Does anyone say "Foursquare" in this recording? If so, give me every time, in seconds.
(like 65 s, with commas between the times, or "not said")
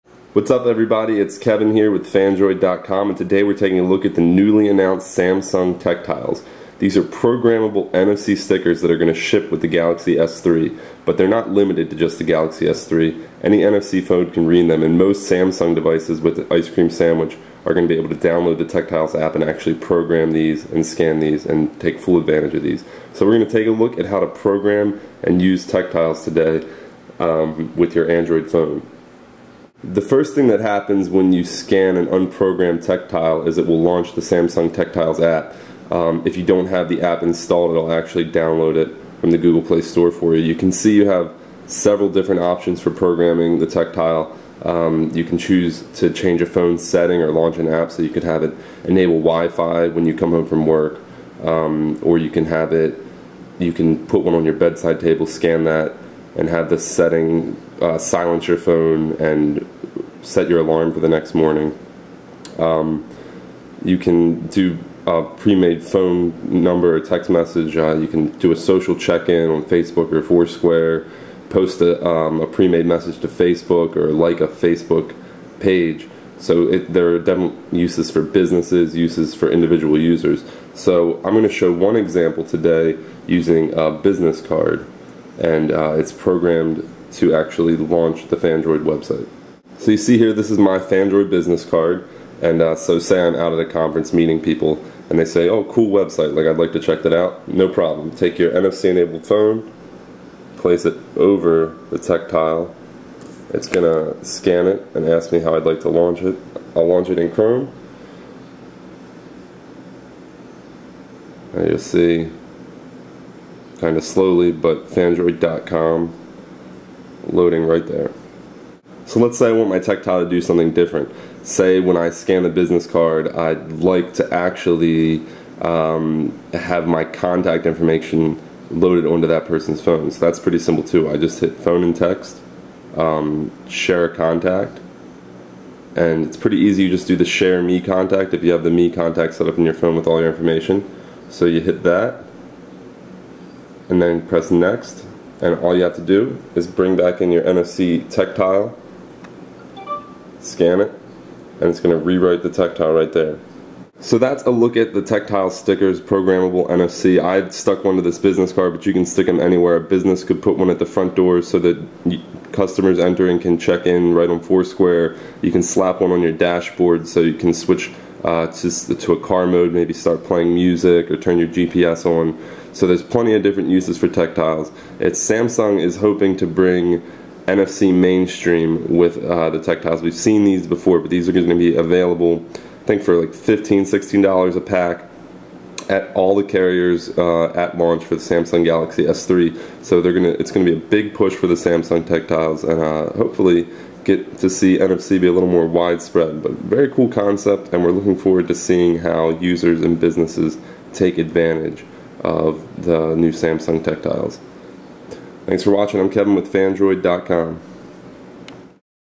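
70 s, 164 s.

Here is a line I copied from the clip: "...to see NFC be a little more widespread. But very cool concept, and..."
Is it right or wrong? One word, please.
right.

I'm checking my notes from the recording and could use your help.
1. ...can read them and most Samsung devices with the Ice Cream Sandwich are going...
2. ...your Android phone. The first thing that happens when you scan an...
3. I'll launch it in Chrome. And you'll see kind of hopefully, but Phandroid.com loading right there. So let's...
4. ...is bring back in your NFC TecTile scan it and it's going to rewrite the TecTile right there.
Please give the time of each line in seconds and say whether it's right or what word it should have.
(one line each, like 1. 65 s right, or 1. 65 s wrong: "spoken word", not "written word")
1. 14 s right
2. 27 s right
3. 106 s wrong: "slowly", not "hopefully"
4. 146 s right.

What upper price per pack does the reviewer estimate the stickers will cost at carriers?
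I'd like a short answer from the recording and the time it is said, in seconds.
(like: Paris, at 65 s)
$16, at 183 s.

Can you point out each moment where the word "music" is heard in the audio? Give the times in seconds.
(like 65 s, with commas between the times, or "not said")
170 s.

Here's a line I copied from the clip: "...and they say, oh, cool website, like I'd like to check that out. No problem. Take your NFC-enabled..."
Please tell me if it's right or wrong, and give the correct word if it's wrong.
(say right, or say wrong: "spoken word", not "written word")
right.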